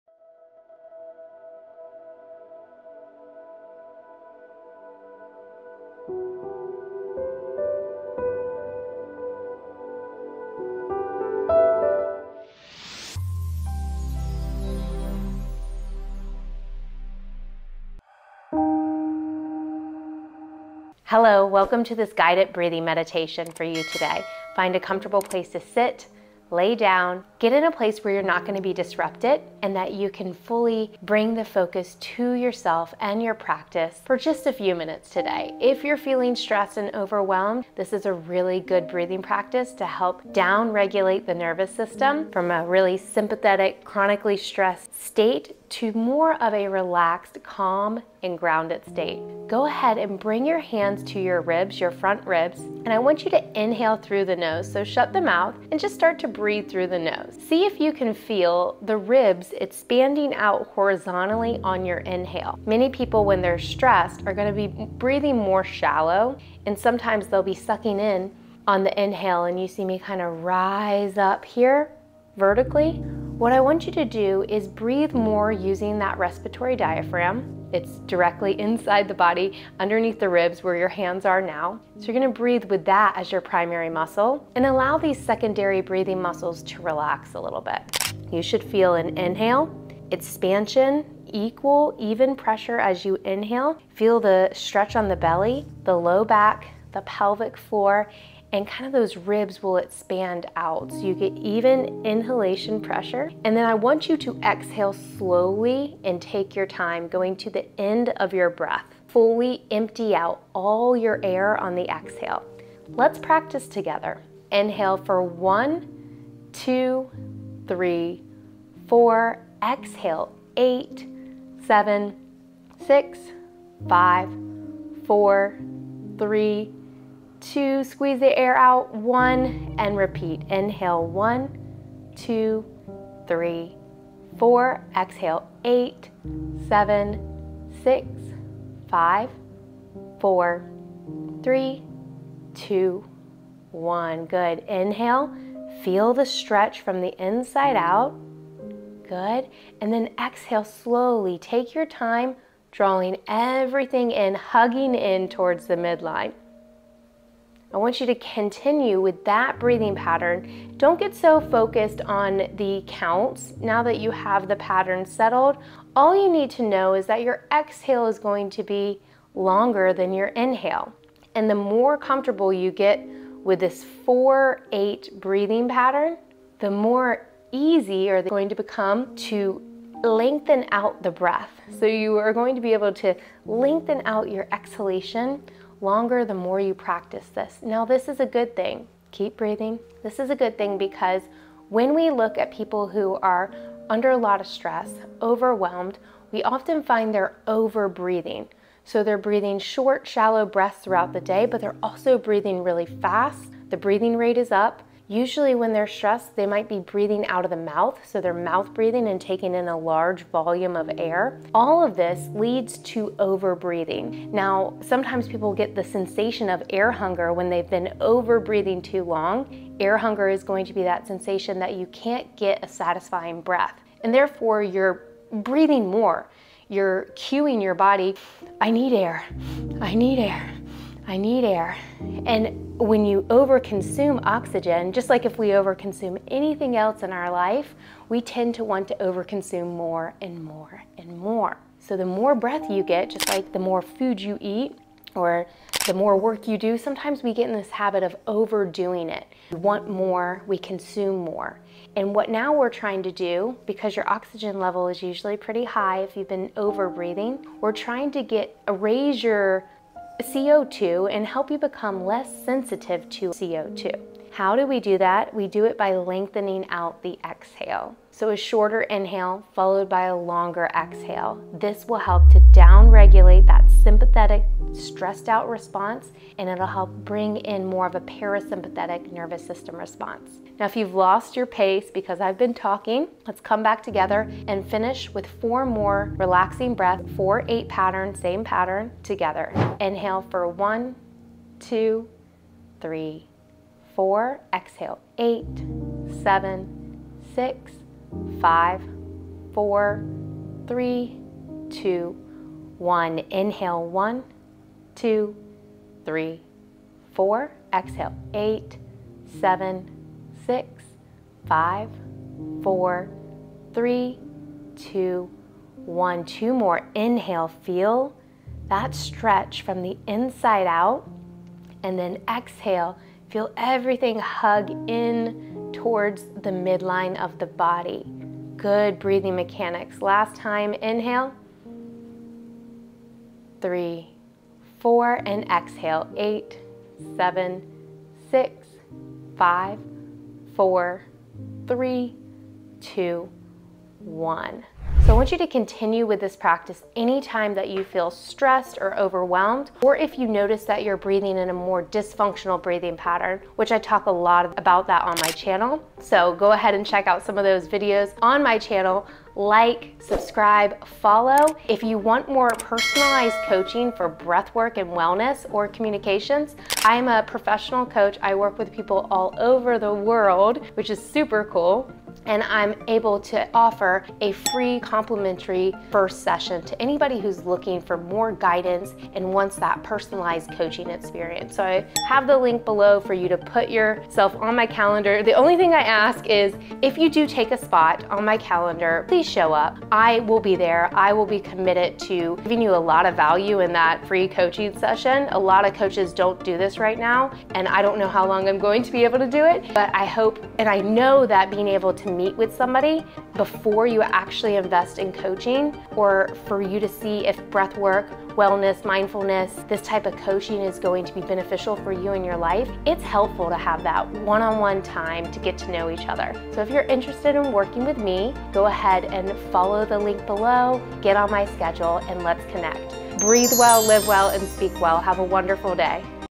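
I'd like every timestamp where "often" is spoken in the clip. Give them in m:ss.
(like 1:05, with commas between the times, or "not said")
3:16.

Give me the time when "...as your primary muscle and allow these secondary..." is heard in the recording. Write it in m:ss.
1:23.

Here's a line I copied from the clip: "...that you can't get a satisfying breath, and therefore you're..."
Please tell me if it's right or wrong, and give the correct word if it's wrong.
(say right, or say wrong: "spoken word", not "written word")
right.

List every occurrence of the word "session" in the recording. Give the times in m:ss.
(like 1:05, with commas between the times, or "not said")
6:16, 6:34.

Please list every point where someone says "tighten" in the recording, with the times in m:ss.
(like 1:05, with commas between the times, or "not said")
not said.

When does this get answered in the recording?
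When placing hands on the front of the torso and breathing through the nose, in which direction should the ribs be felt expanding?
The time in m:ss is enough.
1:00.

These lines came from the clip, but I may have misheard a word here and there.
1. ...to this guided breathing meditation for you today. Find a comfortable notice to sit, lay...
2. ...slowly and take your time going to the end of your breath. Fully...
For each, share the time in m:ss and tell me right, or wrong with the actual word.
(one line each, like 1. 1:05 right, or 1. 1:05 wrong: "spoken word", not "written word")
1. 0:21 wrong: "place", not "notice"
2. 1:45 right.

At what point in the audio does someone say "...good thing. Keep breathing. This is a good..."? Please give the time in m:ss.
3:08.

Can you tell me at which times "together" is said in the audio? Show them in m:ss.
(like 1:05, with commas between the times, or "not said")
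1:53, 4:43, 4:49.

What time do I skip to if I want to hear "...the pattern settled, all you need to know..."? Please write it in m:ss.
2:44.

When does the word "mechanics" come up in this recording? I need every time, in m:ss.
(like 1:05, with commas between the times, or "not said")
5:29.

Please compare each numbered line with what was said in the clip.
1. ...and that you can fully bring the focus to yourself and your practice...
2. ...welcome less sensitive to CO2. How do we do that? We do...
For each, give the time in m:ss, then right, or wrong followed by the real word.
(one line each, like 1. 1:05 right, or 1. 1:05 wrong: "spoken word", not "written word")
1. 0:29 right
2. 4:21 wrong: "become", not "welcome".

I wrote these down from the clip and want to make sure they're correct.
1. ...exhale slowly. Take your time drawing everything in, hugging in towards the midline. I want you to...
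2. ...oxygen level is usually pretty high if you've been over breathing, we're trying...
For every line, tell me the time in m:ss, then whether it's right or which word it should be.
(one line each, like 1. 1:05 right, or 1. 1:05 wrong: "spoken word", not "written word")
1. 2:30 right
2. 4:14 right.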